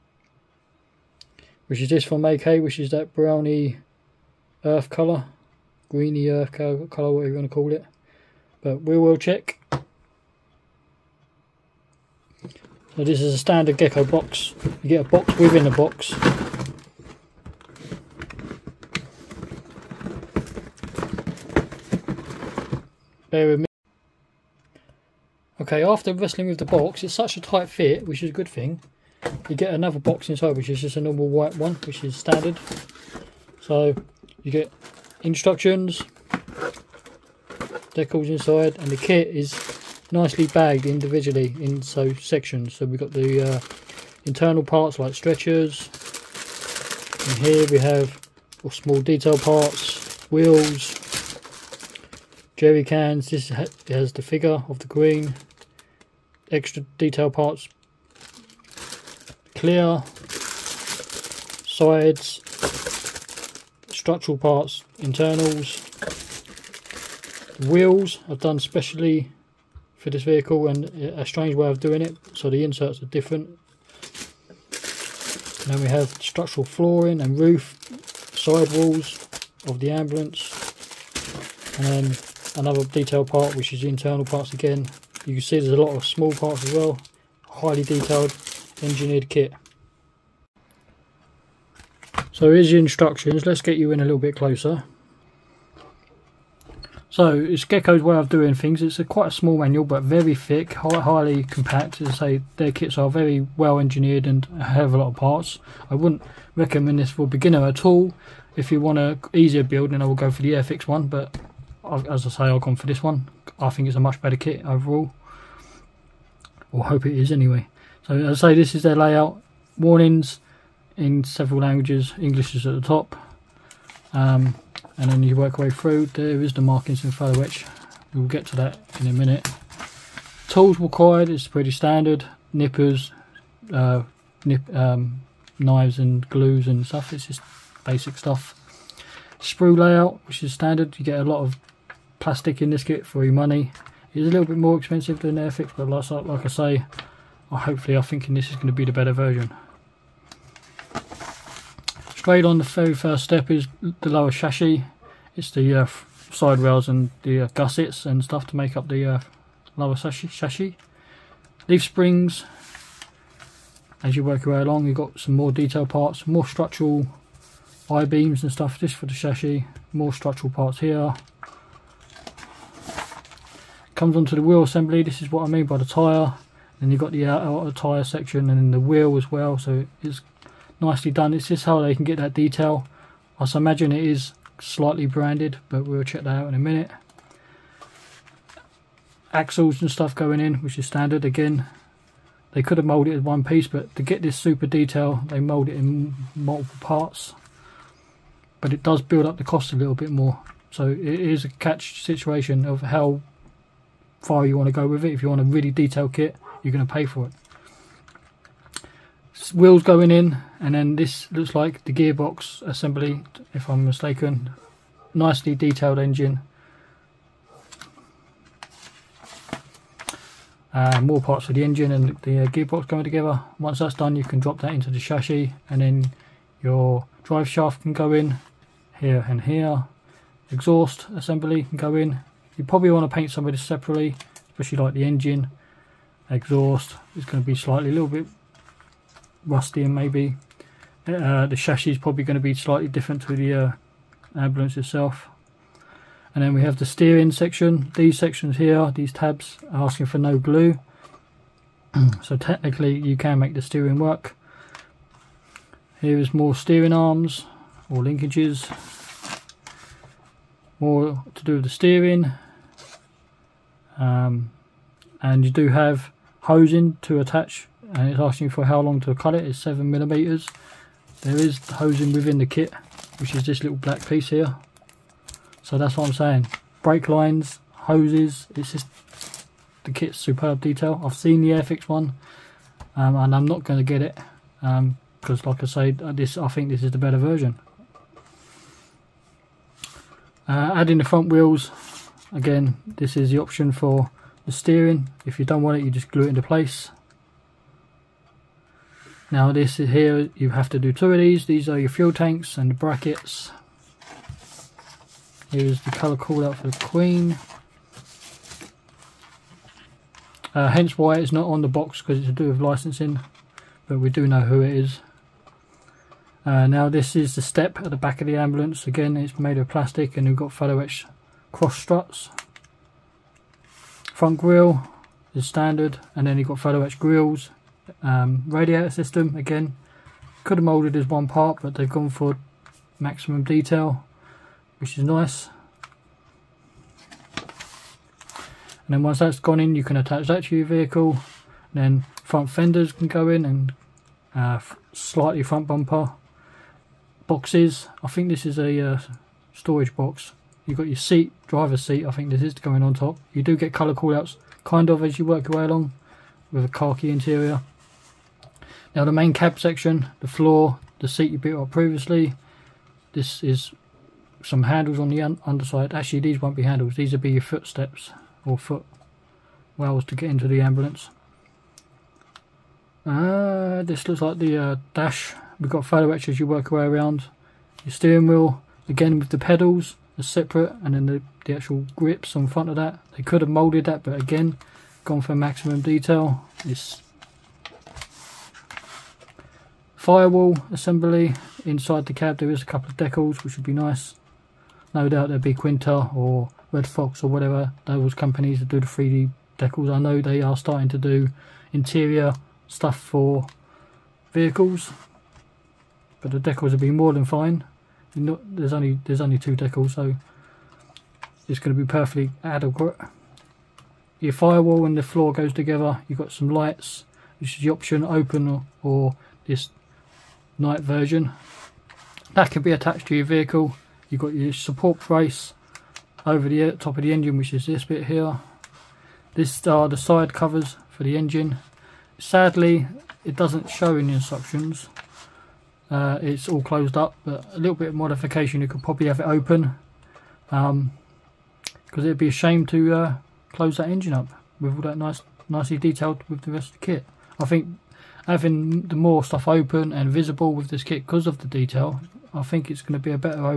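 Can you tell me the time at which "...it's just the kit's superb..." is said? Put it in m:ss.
4:38.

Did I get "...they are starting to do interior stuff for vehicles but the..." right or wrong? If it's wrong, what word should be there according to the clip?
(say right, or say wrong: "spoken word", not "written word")
right.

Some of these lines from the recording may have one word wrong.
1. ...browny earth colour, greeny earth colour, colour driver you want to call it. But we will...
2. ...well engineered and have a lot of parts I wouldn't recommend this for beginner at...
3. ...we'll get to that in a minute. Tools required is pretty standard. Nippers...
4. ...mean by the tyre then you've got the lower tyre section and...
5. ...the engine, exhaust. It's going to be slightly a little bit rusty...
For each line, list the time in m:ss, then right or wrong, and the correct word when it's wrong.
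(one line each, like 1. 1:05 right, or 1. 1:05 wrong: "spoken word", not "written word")
1. 0:03 wrong: "whatever", not "driver"
2. 1:43 right
3. 2:08 right
4. 2:55 wrong: "outer", not "lower"
5. 3:54 right.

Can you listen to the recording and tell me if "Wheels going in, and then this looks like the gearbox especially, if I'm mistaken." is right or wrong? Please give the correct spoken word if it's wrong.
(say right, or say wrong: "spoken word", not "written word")
wrong: "assembly", not "especially".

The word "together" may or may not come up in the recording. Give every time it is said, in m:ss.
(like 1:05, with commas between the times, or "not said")
3:43, 6:55.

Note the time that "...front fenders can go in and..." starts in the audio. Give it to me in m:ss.
5:42.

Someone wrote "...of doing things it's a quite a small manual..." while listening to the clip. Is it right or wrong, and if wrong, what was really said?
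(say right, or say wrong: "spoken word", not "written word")
right.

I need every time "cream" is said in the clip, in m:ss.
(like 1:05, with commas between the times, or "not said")
not said.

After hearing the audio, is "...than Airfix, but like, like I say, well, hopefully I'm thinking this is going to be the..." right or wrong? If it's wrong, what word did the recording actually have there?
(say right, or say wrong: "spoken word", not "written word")
right.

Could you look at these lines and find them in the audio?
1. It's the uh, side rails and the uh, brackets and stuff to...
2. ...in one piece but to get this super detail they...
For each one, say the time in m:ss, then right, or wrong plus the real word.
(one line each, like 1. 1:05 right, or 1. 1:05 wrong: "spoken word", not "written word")
1. 2:35 wrong: "gussets", not "brackets"
2. 3:13 right.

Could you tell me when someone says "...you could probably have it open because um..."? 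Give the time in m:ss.
7:18.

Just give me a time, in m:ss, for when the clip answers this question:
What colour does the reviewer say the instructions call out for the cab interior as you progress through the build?
5:56.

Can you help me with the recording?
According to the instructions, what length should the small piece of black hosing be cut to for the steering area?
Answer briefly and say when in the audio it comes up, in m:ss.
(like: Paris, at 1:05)
7 mm, at 4:29.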